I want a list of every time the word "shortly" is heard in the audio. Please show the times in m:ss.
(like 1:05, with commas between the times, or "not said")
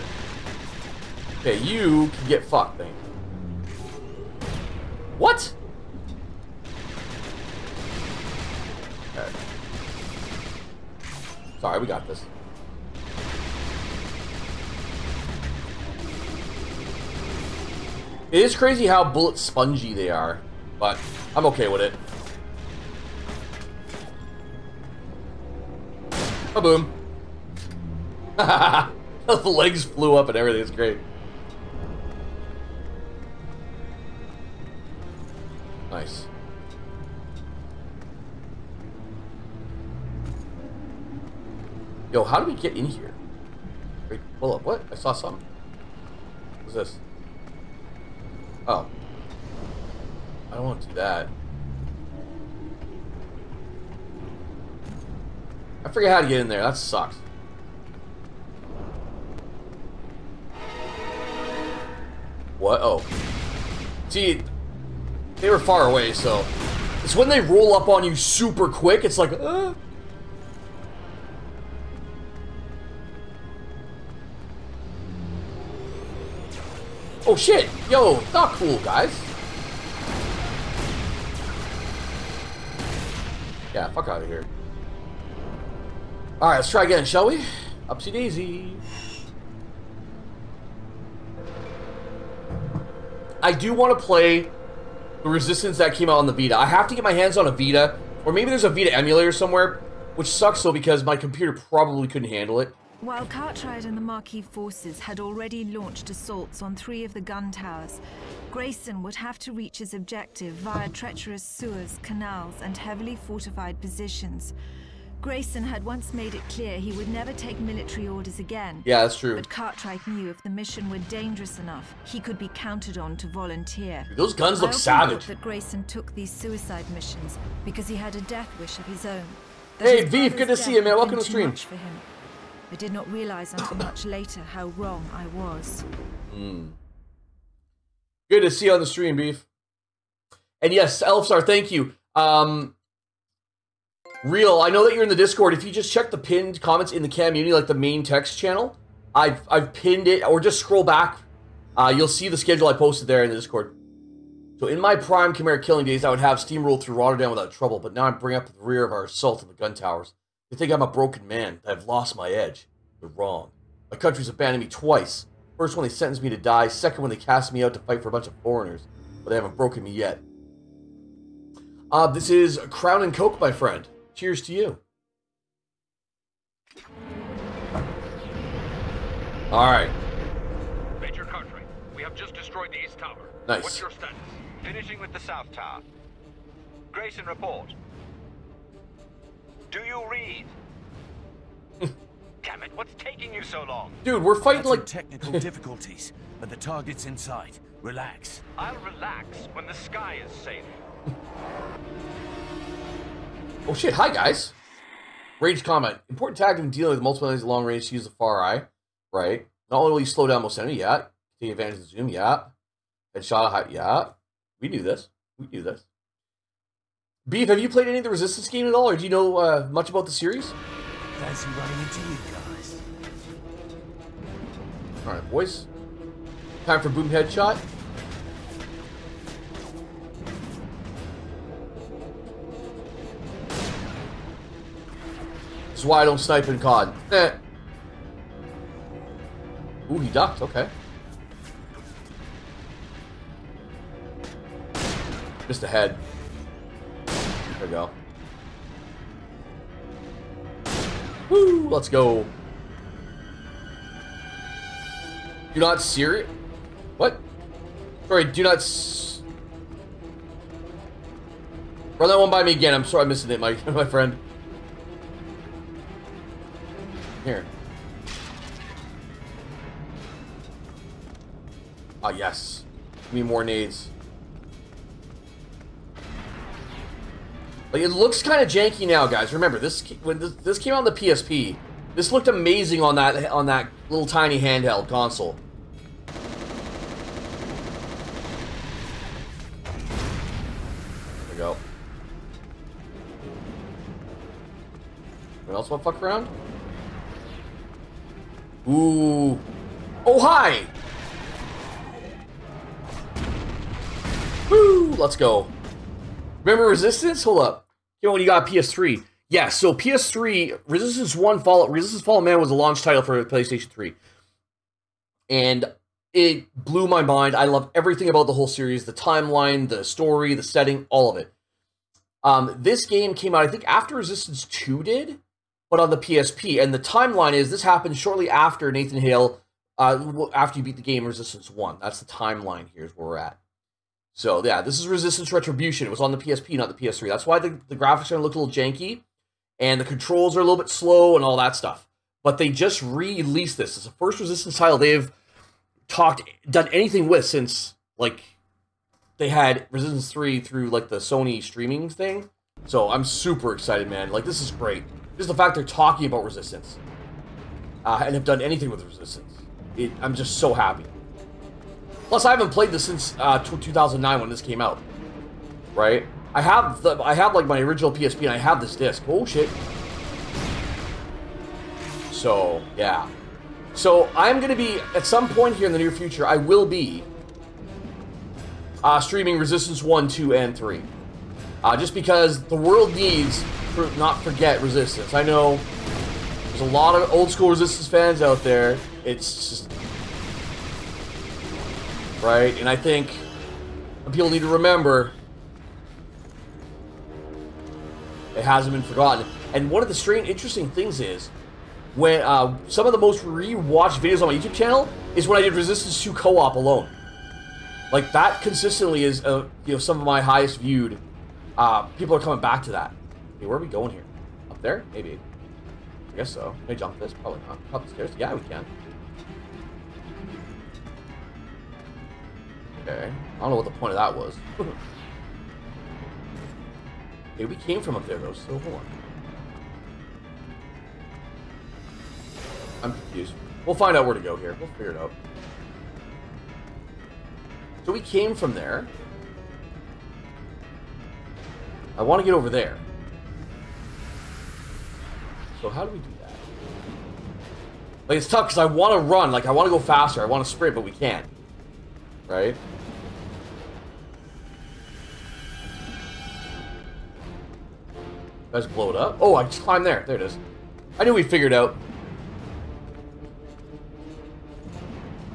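5:27.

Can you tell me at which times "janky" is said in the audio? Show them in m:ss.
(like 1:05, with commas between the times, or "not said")
4:38, 5:38.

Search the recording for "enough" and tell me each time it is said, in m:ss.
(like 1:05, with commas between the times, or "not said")
2:01.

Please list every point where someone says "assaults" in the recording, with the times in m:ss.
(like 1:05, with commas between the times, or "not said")
1:46, 2:39.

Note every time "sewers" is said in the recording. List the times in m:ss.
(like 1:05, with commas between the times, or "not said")
1:51.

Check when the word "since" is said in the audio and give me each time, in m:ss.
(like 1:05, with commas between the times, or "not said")
5:47, 6:02.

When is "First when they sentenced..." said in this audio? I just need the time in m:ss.
2:45.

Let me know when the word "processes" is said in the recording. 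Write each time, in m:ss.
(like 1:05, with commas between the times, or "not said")
not said.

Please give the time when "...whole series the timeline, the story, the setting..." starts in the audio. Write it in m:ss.
5:18.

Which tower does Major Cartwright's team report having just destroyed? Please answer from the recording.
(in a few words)
East Tower.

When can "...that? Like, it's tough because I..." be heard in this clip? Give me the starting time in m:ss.
7:26.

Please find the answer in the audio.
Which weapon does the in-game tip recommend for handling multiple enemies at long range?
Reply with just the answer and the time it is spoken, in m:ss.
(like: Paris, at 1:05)
Fareye, at 3:28.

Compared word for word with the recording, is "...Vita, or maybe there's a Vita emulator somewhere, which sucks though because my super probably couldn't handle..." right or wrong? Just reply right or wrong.
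wrong.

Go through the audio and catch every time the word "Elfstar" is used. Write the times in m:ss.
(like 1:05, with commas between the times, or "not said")
2:21.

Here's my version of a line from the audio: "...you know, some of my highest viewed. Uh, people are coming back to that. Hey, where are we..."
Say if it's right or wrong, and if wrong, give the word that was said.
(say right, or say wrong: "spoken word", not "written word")
right.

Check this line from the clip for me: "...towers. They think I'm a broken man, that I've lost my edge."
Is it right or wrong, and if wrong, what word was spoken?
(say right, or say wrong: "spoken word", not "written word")
right.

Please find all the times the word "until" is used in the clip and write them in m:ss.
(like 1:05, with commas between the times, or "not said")
2:13.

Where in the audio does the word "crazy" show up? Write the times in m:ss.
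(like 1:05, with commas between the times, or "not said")
0:18.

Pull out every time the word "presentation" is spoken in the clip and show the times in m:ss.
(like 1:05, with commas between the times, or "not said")
not said.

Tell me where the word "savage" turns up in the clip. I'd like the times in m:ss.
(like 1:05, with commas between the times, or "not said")
2:04.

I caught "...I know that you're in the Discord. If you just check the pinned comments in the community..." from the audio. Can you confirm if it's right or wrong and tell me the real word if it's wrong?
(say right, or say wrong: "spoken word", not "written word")
right.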